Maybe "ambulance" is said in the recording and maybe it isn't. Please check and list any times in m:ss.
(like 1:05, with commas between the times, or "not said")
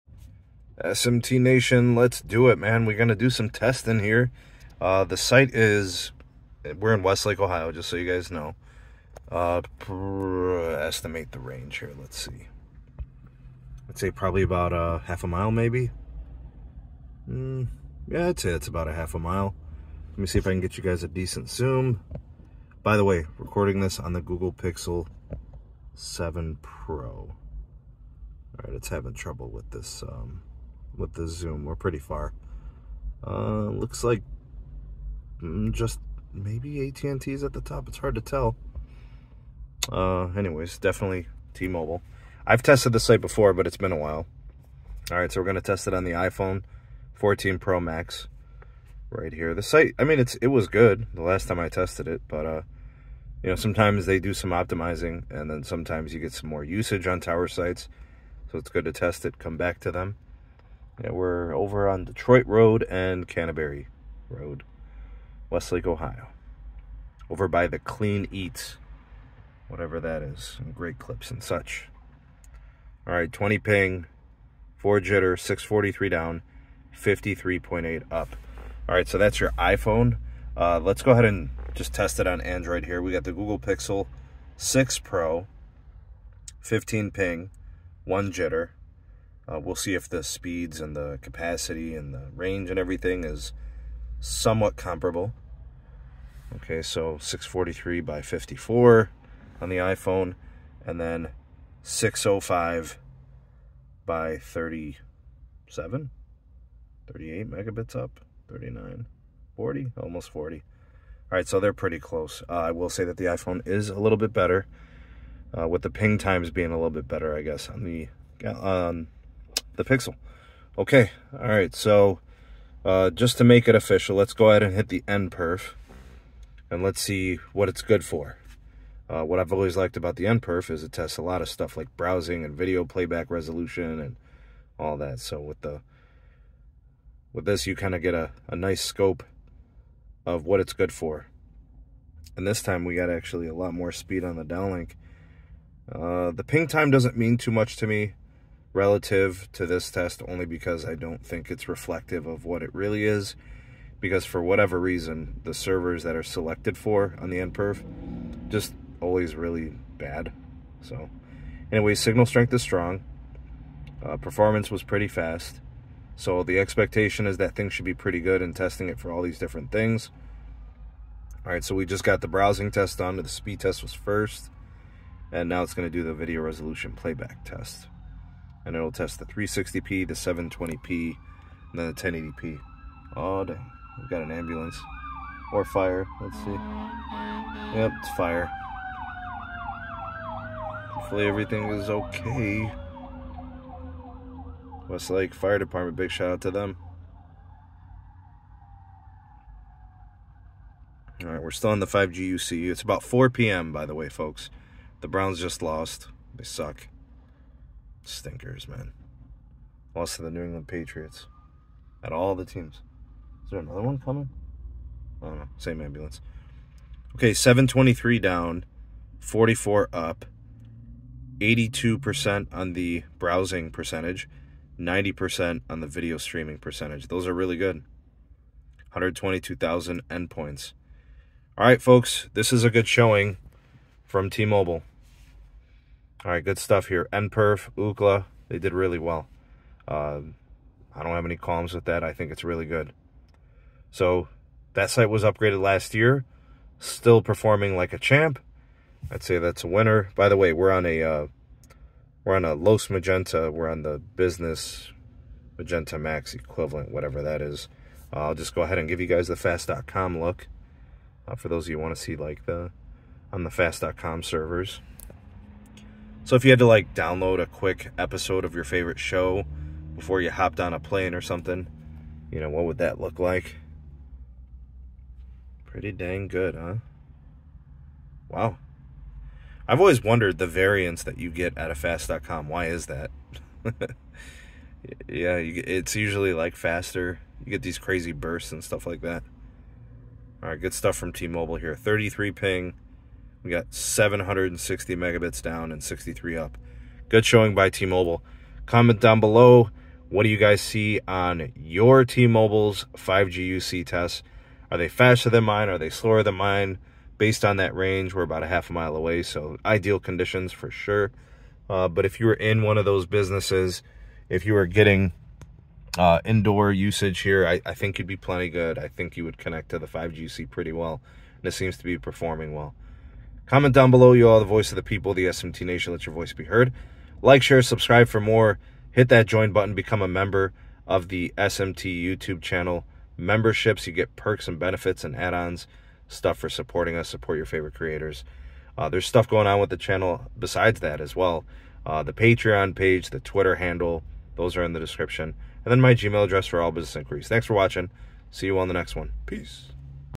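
3:04, 3:35.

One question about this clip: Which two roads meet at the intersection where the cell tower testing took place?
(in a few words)
Detroit Road and Canterbury Road.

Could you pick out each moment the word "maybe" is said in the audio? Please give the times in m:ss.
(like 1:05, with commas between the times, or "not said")
0:15, 0:36.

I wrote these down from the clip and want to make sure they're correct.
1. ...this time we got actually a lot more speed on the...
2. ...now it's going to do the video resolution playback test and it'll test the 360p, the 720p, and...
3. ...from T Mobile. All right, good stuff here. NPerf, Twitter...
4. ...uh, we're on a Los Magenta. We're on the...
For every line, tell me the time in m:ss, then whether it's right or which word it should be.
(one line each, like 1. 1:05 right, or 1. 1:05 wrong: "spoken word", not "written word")
1. 2:22 right
2. 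2:55 right
3. 3:54 wrong: "UCLA", not "Twitter"
4. 4:11 right.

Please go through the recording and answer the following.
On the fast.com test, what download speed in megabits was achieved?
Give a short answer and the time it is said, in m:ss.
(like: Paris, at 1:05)
760, at 4:53.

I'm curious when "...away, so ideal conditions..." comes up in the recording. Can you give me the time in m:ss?
5:08.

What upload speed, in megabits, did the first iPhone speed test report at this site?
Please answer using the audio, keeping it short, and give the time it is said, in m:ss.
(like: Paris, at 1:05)
53.8, at 1:16.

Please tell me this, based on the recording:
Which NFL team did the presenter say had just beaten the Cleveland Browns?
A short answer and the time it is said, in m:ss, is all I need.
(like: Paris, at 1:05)
New England Patriots, at 3:30.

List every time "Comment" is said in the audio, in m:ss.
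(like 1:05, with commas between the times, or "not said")
4:58, 5:23.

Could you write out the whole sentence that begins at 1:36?
Okay, so 643 by 54 on the iPhone, and then 605 by 37, 38 megabits up, 39, 40, almost 40.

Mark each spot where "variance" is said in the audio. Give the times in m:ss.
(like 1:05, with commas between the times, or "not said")
4:40.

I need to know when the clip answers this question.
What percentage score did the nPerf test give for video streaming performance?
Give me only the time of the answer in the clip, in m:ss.
3:44.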